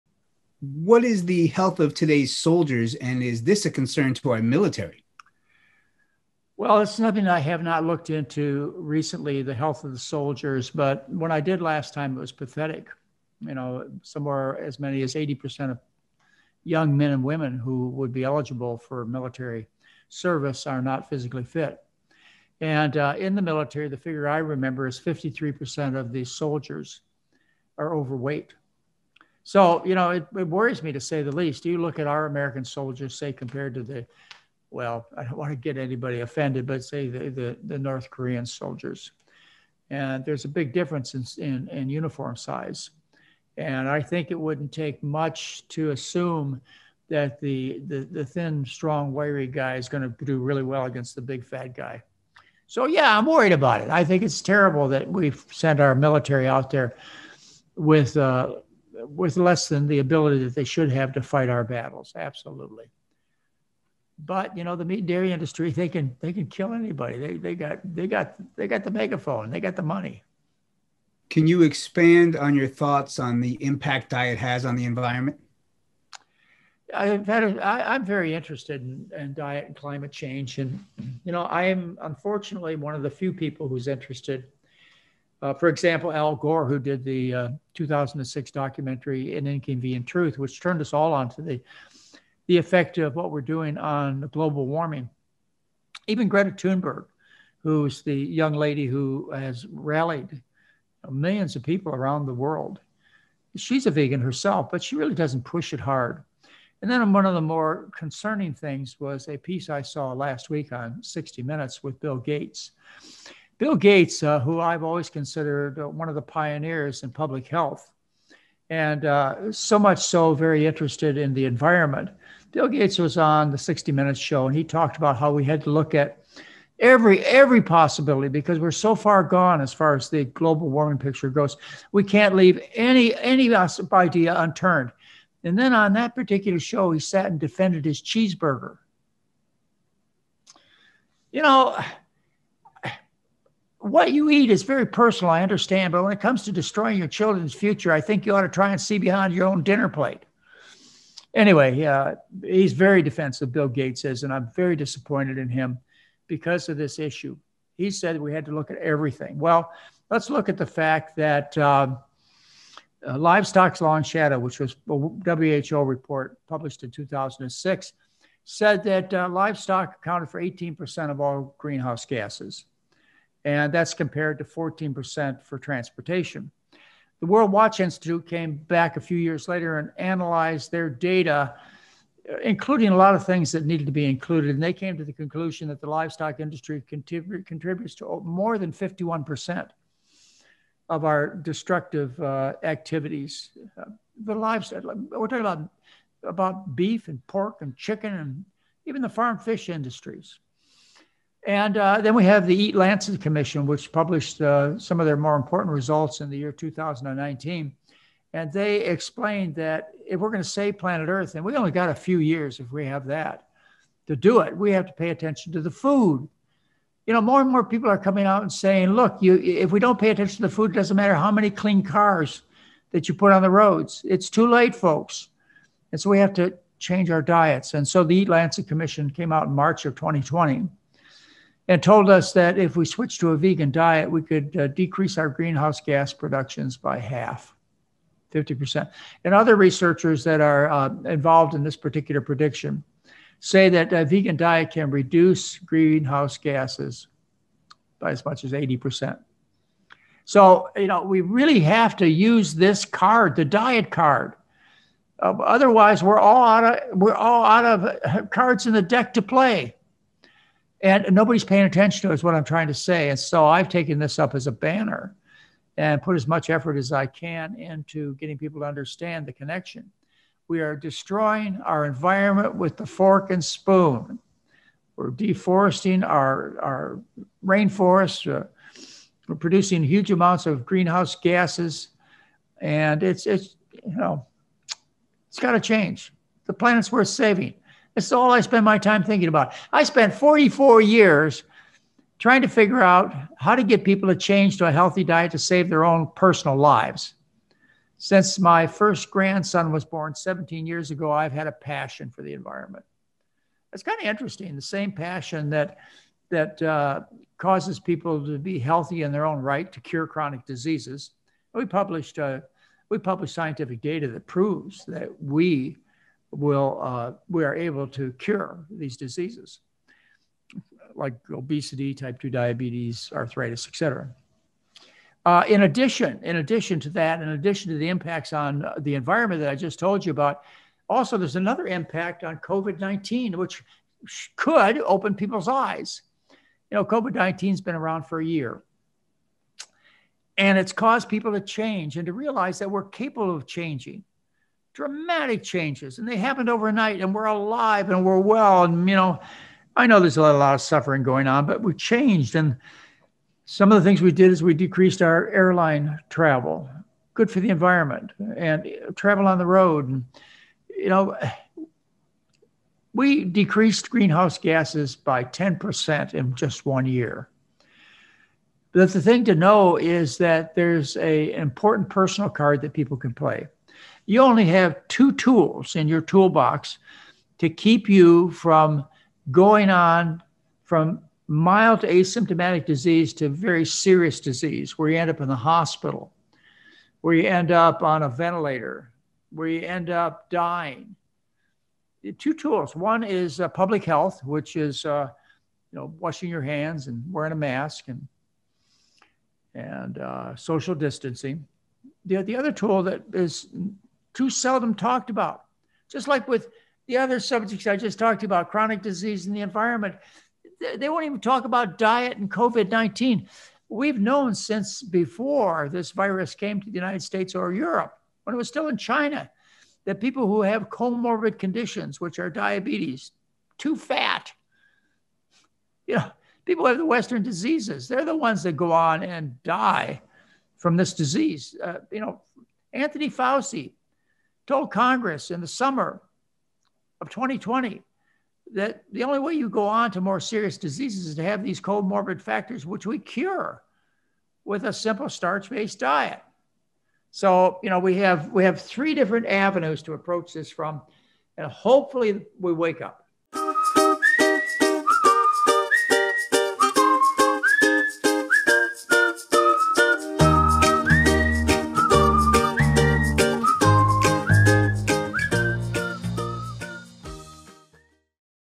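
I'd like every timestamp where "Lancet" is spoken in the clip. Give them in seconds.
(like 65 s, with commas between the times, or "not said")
202 s, 228 s.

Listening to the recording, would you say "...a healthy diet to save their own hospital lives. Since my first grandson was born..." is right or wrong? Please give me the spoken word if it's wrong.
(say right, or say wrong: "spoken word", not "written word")
wrong: "personal", not "hospital".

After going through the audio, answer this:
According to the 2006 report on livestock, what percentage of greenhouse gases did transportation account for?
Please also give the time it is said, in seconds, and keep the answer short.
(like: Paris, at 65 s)
14%, at 174 s.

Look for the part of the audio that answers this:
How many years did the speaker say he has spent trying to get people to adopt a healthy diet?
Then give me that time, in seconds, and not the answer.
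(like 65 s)
290 s.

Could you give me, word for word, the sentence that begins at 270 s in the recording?
We are destroying our environment with the fork and spoon.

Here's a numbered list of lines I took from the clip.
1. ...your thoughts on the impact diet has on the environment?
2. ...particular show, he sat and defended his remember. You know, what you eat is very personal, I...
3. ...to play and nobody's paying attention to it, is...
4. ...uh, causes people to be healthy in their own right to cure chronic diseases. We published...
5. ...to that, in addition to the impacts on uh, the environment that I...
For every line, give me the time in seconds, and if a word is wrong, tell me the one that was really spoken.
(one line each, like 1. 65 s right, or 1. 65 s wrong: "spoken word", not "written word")
1. 72 s right
2. 136 s wrong: "cheeseburger", not "remember"
3. 259 s right
4. 306 s right
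5. 326 s right.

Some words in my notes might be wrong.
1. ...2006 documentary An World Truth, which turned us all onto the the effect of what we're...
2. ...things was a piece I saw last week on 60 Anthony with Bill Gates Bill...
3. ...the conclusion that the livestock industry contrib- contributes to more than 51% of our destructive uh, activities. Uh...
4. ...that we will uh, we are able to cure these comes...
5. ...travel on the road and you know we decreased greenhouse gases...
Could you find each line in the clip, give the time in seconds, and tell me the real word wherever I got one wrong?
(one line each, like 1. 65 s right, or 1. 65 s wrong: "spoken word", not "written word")
1. 87 s wrong: "Inconvenient", not "World"
2. 108 s wrong: "Minutes", not "Anthony"
3. 185 s right
4. 314 s wrong: "diseases", not "comes"
5. 358 s right.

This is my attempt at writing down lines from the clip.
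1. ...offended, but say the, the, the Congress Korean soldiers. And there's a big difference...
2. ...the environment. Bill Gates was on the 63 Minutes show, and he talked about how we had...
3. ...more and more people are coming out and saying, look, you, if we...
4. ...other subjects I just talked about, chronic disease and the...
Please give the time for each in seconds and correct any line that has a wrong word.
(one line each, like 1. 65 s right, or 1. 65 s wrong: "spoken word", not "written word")
1. 36 s wrong: "North", not "Congress"
2. 121 s wrong: "60", not "63"
3. 217 s right
4. 406 s right.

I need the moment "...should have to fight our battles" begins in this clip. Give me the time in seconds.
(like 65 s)
60 s.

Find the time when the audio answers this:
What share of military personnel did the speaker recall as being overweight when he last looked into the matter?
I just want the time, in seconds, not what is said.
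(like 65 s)
24 s.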